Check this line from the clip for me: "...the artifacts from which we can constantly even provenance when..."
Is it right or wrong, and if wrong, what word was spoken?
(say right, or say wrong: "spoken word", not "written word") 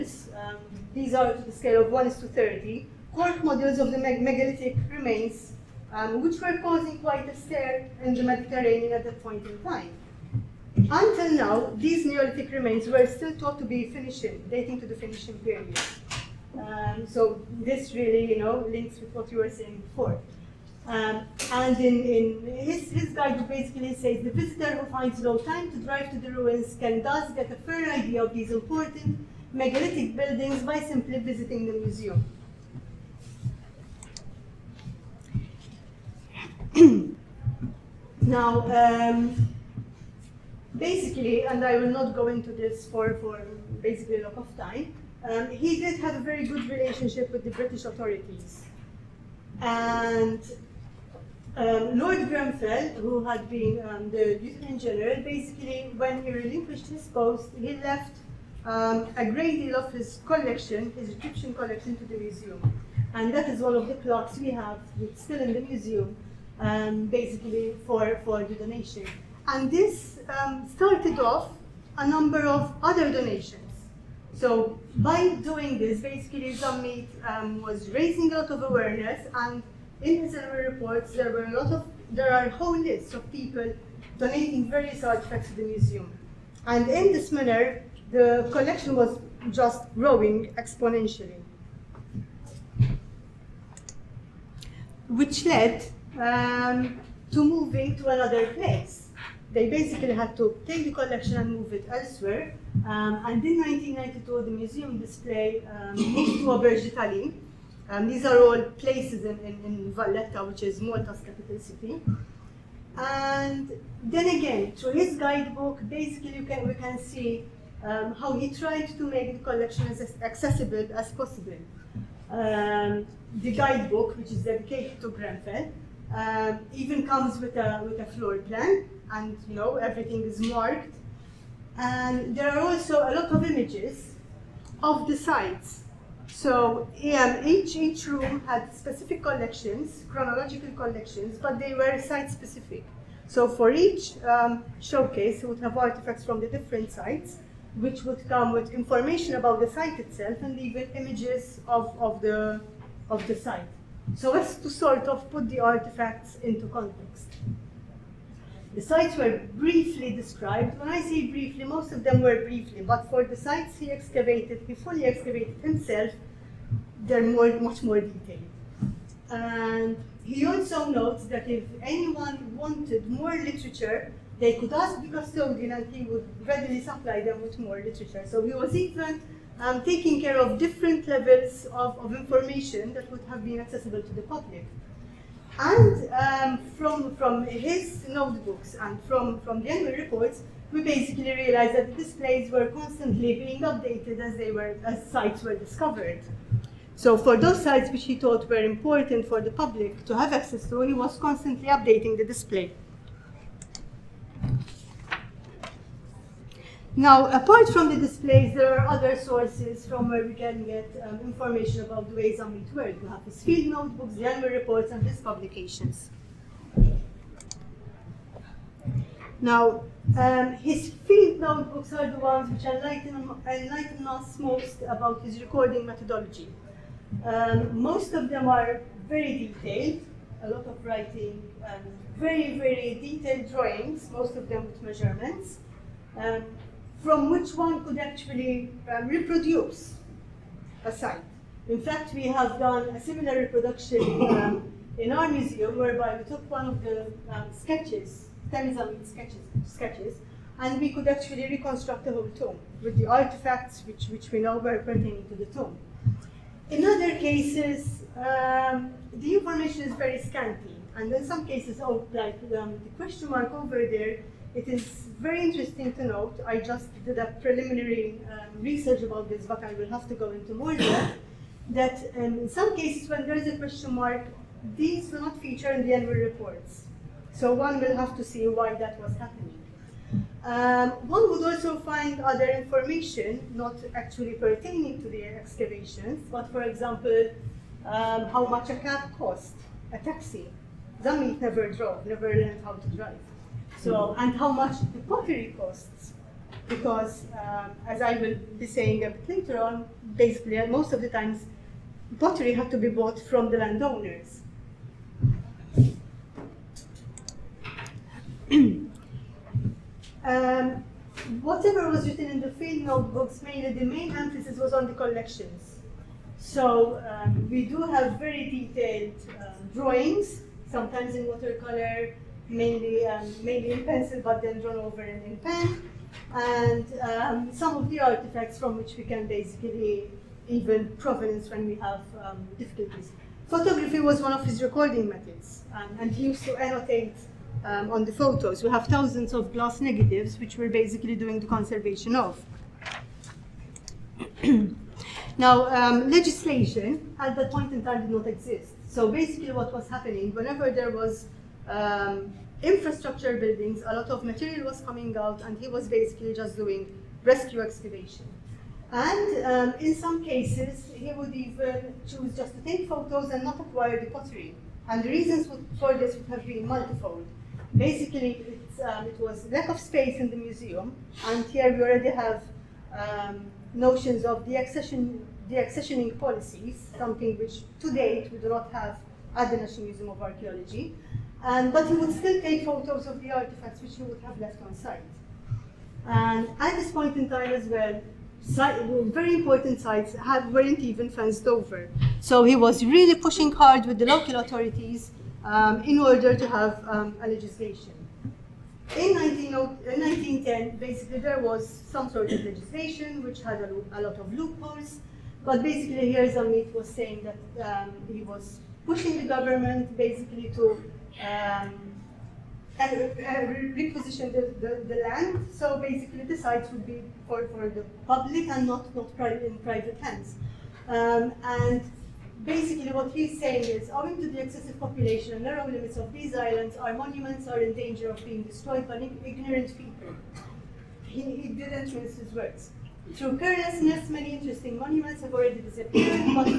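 wrong: "basically", not "constantly".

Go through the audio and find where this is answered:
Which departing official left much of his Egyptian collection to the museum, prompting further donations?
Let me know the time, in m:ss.
0:51.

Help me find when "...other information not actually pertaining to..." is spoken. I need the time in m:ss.
4:42.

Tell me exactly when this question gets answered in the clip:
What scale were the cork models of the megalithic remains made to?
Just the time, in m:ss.
0:01.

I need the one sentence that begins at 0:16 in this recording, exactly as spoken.
Um, so this really, you know, links with what you were saying before.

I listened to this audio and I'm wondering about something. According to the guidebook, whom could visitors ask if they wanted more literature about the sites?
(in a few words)
The custodian.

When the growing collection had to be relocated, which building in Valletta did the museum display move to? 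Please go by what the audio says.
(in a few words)
Auberge d'Italie.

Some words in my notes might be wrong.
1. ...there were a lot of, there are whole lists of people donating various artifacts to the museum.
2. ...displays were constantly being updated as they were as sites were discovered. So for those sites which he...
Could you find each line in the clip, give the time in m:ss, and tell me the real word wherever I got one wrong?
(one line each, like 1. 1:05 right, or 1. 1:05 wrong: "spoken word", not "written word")
1. 1:21 right
2. 3:12 right.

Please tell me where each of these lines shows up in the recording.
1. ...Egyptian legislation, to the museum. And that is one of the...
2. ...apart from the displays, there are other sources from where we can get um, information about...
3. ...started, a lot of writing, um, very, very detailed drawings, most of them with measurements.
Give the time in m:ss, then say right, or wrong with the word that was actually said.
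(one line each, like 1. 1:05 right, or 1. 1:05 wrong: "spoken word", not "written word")
1. 1:01 wrong: "collection", not "legislation"
2. 3:27 right
3. 3:49 wrong: "detailed", not "started".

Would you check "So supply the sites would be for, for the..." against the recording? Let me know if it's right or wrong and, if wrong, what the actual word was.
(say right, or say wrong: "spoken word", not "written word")
wrong: "basically", not "supply".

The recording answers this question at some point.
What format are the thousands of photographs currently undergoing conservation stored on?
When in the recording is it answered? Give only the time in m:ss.
5:39.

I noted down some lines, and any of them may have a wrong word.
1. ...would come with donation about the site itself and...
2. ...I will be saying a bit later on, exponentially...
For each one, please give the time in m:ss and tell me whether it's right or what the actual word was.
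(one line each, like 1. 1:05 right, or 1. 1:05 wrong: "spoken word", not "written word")
1. 2:28 wrong: "information", not "donation"
2. 4:58 wrong: "basically", not "exponentially".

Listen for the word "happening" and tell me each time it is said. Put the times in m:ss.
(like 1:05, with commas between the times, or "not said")
4:39, 5:49.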